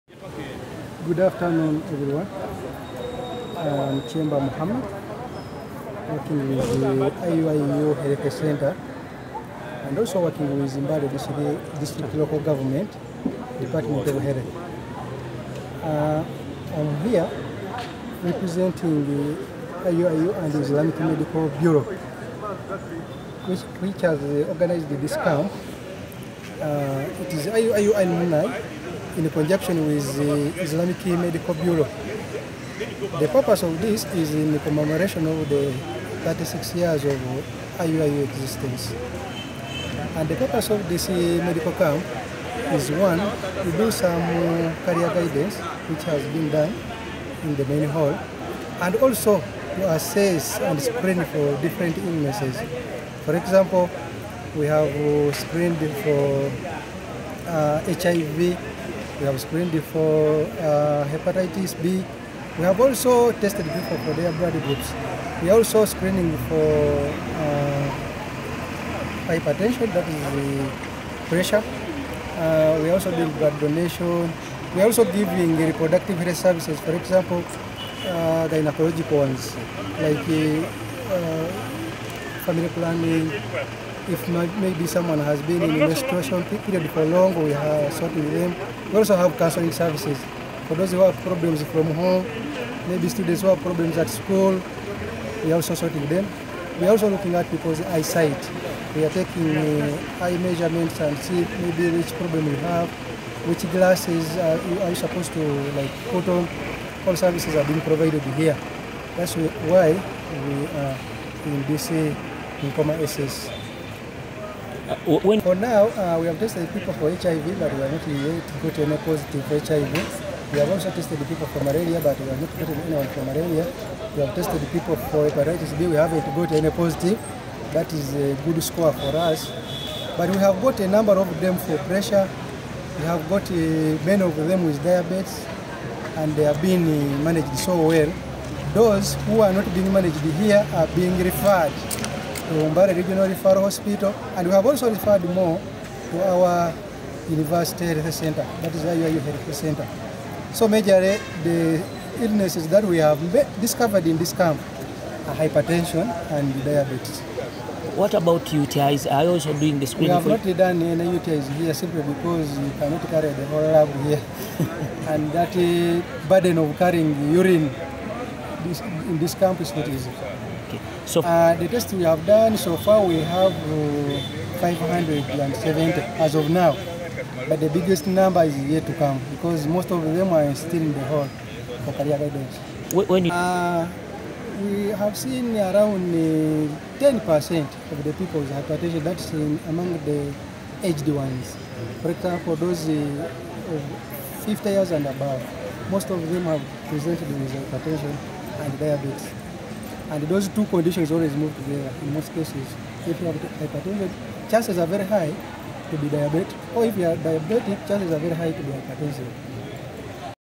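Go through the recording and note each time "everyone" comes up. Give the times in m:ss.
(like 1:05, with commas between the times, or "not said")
0:01.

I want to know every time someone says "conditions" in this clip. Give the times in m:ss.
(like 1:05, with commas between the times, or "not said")
3:20.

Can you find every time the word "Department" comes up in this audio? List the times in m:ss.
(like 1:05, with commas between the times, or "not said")
0:13.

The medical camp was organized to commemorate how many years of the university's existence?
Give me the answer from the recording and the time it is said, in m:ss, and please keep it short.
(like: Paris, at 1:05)
36, at 0:36.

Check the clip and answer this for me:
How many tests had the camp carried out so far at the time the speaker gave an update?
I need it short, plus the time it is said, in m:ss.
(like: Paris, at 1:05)
570, at 2:54.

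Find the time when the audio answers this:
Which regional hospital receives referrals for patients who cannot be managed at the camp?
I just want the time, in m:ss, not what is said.
2:22.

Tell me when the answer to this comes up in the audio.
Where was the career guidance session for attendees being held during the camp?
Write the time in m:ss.
0:47.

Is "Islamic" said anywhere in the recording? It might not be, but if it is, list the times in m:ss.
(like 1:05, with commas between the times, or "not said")
0:20, 0:30.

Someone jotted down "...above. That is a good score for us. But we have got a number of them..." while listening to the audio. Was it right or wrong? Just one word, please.
wrong.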